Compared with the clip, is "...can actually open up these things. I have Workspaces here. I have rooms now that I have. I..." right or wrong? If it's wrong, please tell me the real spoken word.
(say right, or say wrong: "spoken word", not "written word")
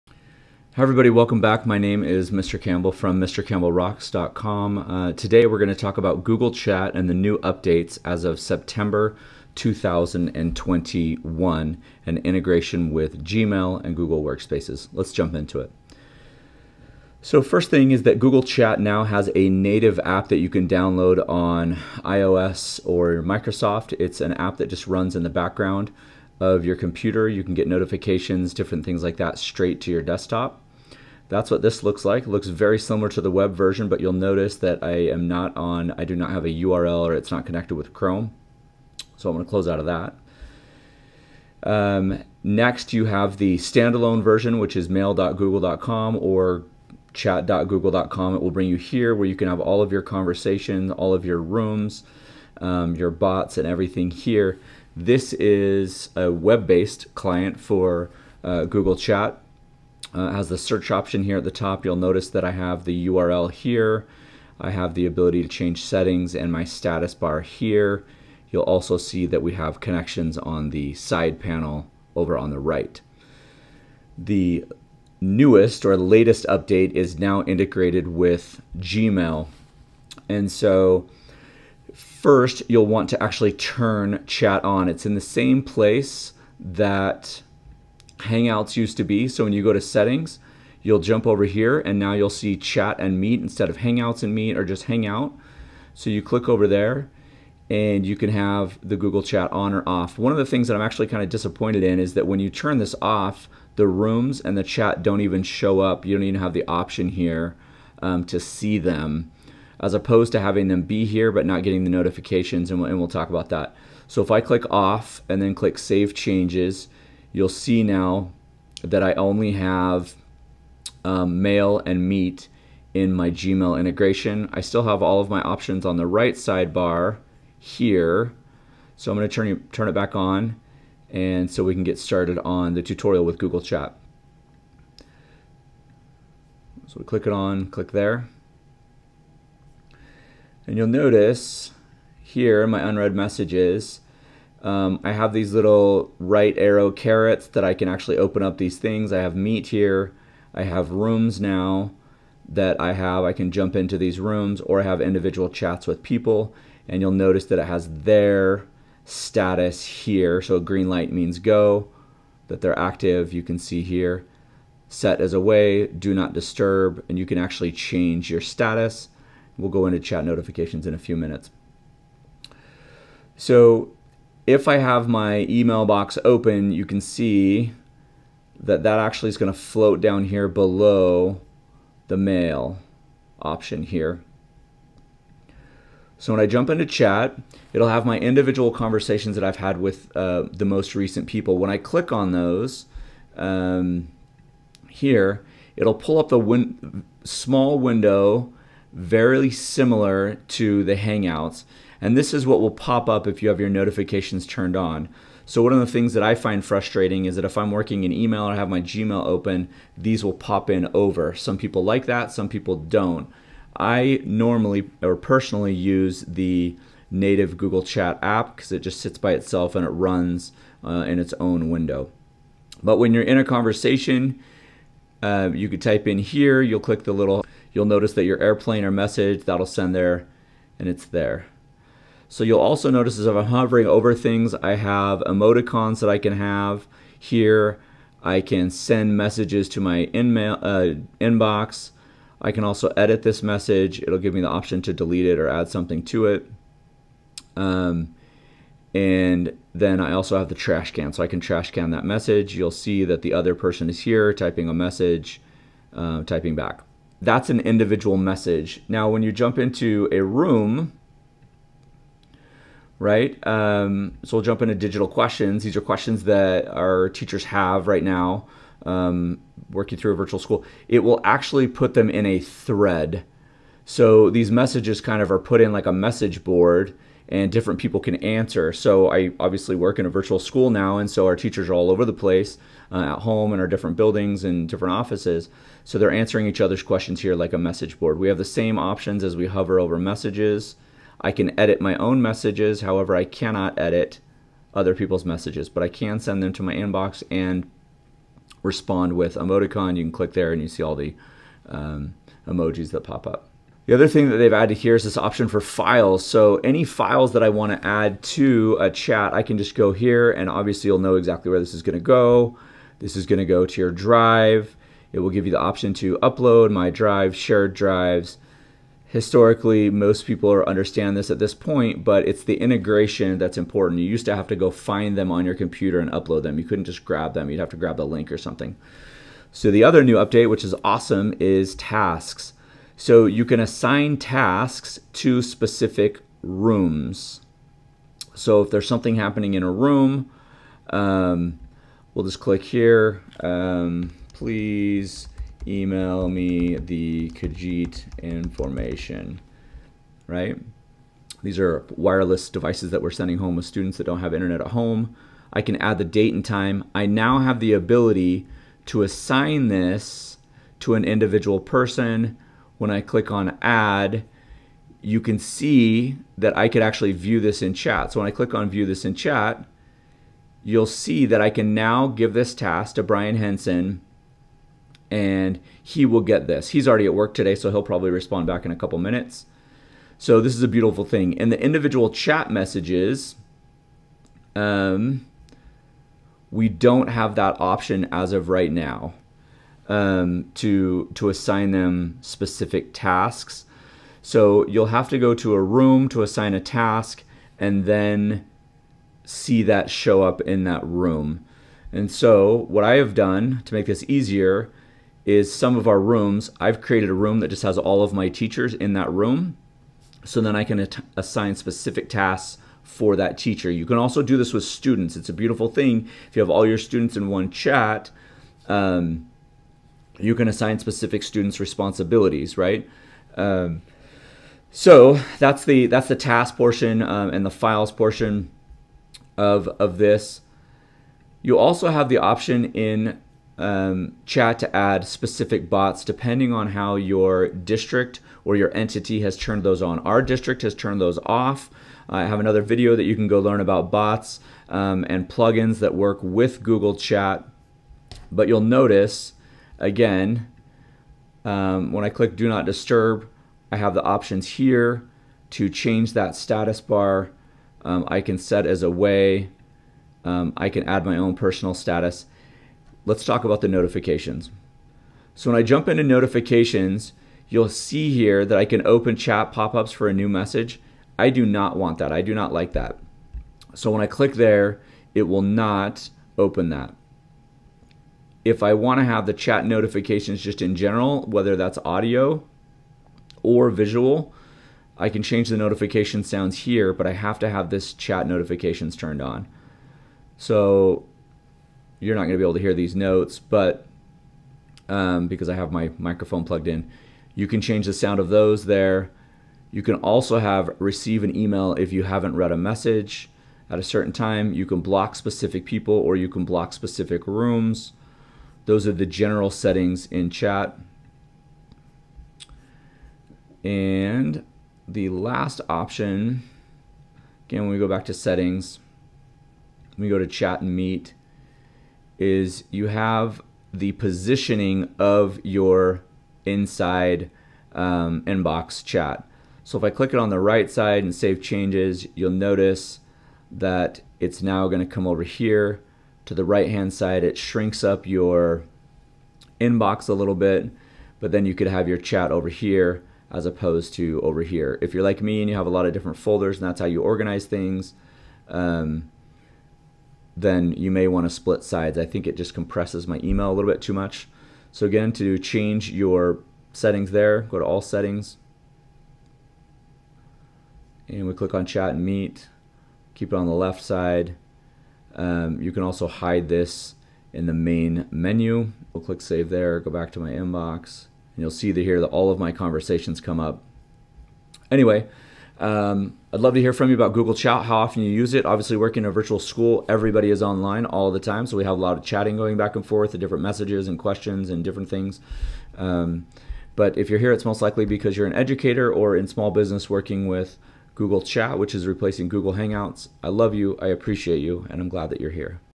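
wrong: "Meet", not "Workspaces".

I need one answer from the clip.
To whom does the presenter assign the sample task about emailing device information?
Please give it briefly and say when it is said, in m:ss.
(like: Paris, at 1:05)
Brian Henson, at 6:13.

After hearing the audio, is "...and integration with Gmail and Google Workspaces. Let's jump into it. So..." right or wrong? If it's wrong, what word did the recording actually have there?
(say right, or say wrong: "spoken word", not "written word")
right.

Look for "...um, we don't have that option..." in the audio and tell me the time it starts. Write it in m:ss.
6:24.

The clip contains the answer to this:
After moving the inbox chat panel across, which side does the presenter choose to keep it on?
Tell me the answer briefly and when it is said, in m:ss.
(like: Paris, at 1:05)
Left side, at 9:23.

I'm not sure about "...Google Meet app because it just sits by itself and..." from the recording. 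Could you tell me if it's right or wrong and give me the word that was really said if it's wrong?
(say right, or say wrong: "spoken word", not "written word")
wrong: "Chat", not "Meet".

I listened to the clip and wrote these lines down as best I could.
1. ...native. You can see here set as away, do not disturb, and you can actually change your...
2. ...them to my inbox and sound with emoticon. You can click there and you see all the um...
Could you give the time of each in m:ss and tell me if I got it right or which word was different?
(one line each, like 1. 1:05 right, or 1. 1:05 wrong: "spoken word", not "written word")
1. 2:42 wrong: "active", not "native"
2. 4:56 wrong: "respond", not "sound".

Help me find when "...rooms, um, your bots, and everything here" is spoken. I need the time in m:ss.
0:51.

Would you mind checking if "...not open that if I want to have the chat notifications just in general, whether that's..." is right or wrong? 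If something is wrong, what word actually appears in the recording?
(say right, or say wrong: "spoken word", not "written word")
right.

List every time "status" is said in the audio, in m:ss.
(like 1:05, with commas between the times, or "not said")
1:06, 2:39, 2:48, 7:36, 7:41.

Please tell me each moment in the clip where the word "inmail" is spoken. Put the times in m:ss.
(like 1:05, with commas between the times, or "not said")
4:00.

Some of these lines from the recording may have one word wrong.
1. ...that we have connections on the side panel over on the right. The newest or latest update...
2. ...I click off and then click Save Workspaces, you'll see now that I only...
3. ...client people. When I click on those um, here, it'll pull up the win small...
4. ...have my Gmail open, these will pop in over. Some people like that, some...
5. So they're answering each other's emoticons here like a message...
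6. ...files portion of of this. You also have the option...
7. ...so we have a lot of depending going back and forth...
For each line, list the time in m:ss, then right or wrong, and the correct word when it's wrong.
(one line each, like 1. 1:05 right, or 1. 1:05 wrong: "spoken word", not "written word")
1. 1:09 right
2. 1:54 wrong: "Changes", not "Workspaces"
3. 3:10 wrong: "recent", not "client"
4. 3:28 right
5. 4:45 wrong: "questions", not "emoticons"
6. 7:07 right
7. 9:41 wrong: "chatting", not "depending".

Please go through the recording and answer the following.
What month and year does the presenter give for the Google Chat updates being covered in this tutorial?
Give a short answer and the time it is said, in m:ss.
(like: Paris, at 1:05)
September 2021, at 0:08.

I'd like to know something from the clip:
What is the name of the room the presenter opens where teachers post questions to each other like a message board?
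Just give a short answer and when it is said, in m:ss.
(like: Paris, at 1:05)
Digital questions, at 4:24.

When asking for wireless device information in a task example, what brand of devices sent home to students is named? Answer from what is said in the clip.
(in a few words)
Kajeet.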